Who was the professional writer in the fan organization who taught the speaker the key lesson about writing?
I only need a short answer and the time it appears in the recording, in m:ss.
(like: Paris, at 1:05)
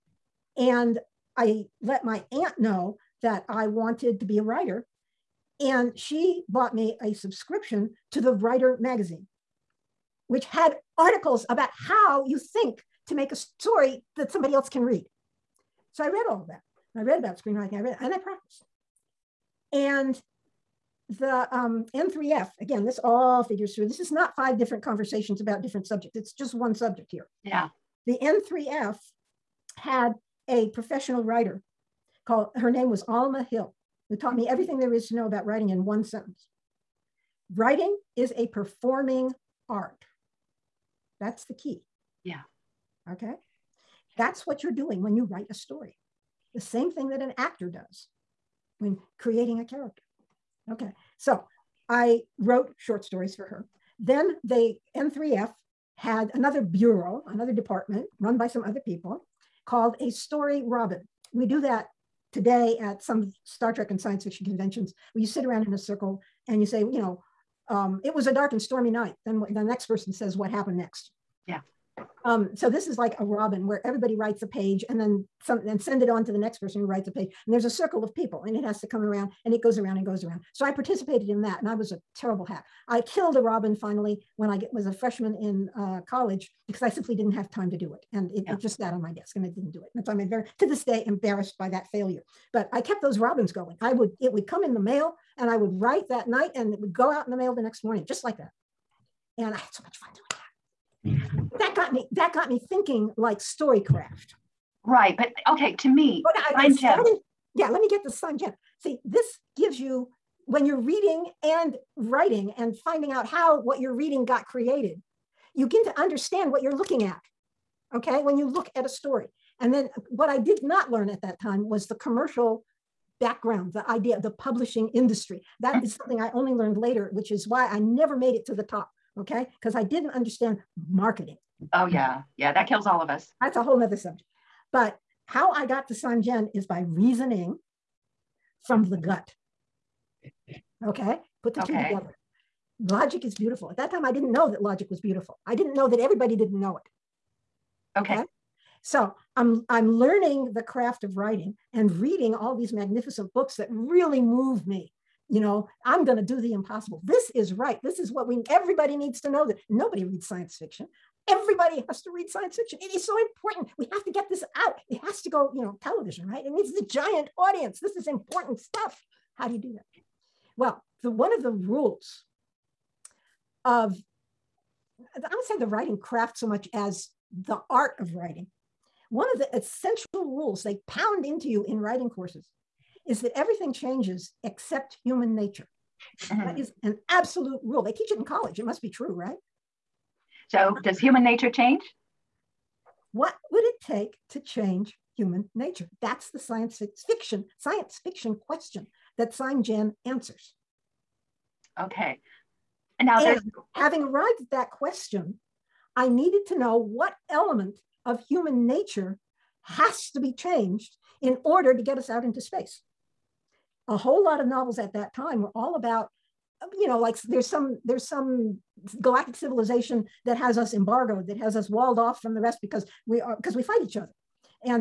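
Alma Hill, at 0:33.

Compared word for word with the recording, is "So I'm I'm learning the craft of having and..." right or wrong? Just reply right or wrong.
wrong.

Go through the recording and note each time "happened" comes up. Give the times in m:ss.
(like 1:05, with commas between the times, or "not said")
1:10.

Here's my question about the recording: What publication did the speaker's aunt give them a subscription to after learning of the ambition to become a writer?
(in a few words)
The Writer magazine.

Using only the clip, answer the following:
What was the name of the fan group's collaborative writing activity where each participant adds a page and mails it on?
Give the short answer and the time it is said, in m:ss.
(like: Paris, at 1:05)
story robin, at 1:00.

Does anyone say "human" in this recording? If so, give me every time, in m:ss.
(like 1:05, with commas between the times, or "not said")
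3:05, 3:10, 3:15, 3:28.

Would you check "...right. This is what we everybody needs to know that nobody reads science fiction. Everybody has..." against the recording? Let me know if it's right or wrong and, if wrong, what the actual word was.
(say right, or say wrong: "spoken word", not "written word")
right.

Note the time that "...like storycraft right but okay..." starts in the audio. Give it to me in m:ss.
1:43.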